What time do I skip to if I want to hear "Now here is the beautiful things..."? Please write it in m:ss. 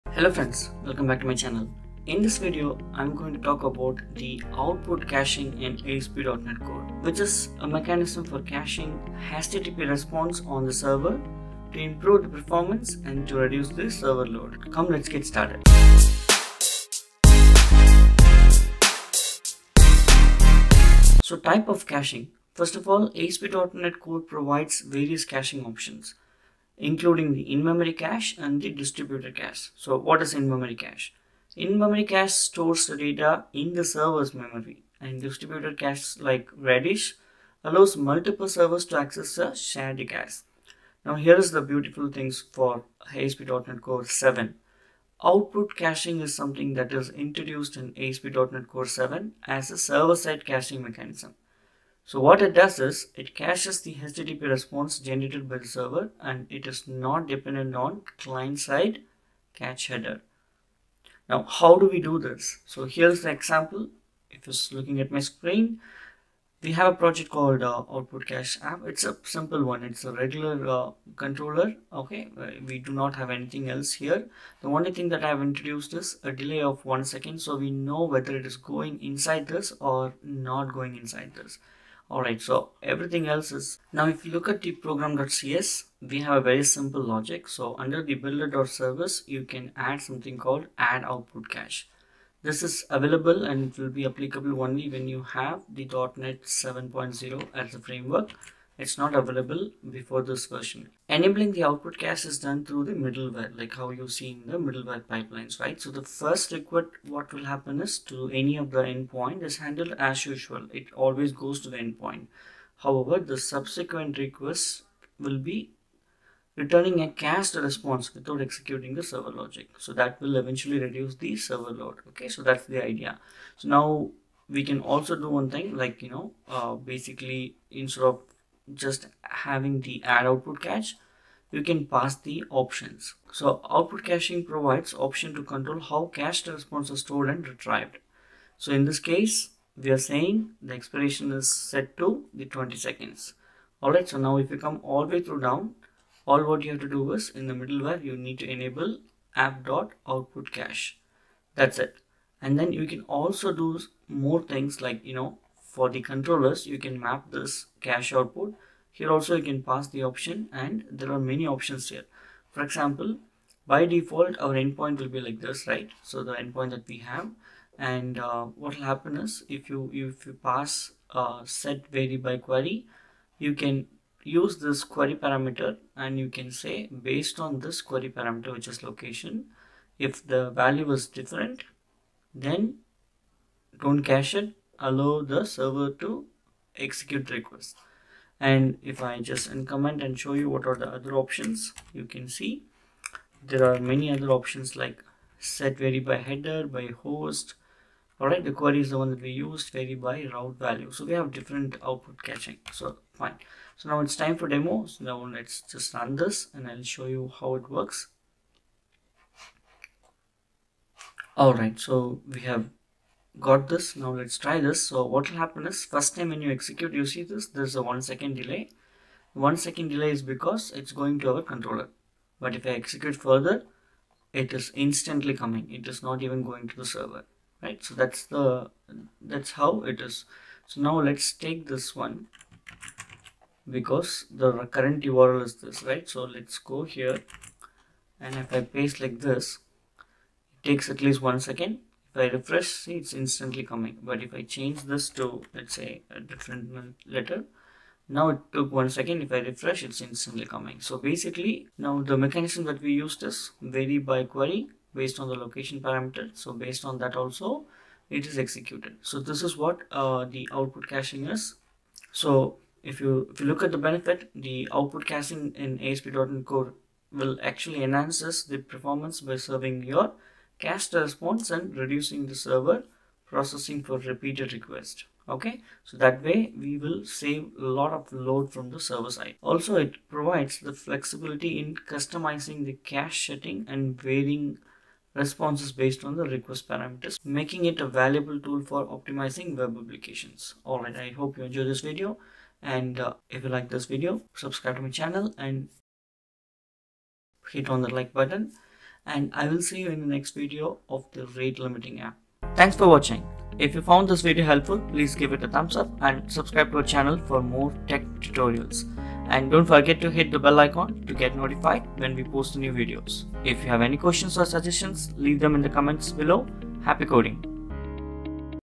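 0:41.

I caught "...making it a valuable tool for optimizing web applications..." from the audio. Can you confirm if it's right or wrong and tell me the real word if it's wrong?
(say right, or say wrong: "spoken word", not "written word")
right.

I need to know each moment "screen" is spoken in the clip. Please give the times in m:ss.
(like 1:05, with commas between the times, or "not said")
1:05.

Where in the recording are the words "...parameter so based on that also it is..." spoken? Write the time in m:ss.
4:15.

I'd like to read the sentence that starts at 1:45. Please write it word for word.
So the first request, what will happen is to any of the endpoint is handled as usual.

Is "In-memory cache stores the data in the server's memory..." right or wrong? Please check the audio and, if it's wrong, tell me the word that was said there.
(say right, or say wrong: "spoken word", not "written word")
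right.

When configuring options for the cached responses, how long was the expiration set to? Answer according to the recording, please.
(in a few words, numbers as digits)
20 seconds.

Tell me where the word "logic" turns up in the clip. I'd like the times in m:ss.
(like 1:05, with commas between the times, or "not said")
1:27, 1:59.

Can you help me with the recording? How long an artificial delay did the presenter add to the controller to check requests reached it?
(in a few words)
1 second.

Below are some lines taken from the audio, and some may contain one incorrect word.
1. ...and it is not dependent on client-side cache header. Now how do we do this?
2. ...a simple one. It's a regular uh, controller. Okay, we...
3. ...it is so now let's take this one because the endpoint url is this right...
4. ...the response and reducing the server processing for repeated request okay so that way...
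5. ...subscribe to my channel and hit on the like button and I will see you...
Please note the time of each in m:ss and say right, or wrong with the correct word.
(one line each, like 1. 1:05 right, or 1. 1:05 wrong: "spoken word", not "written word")
1. 0:56 right
2. 1:09 right
3. 3:49 wrong: "current", not "endpoint"
4. 4:30 right
5. 4:54 right.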